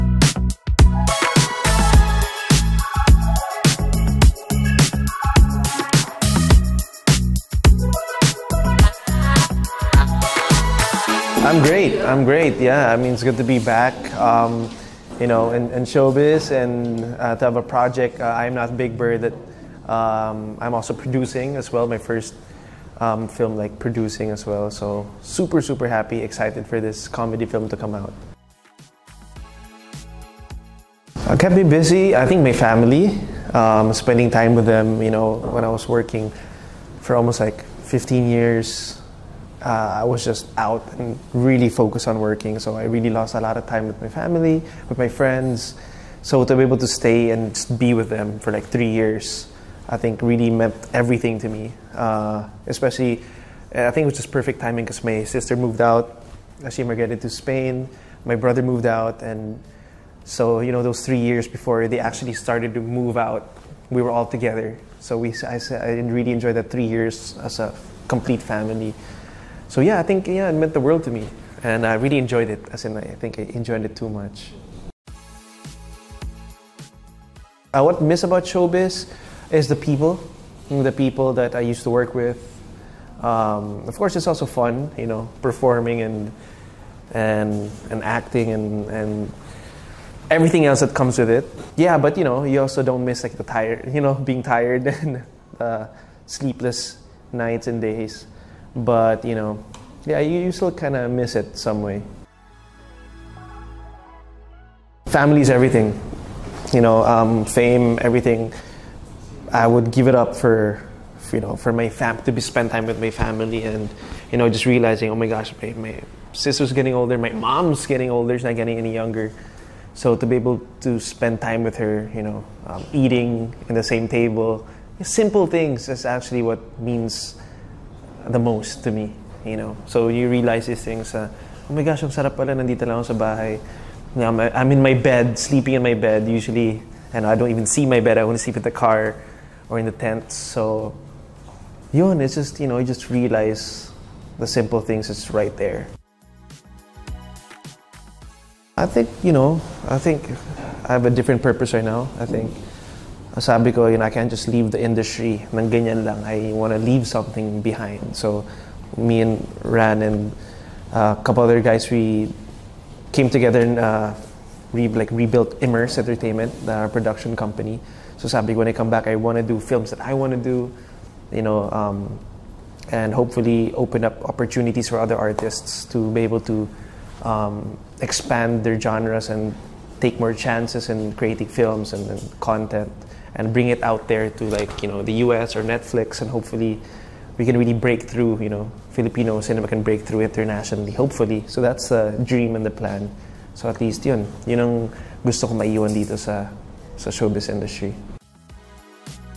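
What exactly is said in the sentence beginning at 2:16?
Usually, and I don't even see my bed.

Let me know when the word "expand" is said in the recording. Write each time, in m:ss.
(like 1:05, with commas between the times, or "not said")
2:58.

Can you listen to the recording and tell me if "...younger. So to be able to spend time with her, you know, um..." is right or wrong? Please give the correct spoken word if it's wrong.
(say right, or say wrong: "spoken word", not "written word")
right.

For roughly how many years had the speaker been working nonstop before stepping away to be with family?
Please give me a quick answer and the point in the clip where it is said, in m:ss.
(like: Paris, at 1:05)
15 years, at 0:37.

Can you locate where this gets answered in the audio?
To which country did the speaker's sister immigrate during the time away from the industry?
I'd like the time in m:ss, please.
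0:57.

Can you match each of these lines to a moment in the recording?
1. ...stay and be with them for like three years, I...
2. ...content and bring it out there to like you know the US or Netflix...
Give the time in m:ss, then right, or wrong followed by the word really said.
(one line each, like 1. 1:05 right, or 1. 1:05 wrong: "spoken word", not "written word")
1. 0:46 right
2. 3:02 right.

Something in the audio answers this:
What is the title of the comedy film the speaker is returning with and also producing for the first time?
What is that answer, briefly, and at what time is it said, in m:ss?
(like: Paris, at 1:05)
I'm Not Big Bird, at 0:18.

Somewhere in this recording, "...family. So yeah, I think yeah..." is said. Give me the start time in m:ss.
1:08.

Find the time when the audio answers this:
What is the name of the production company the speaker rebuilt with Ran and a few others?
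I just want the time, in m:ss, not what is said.
2:45.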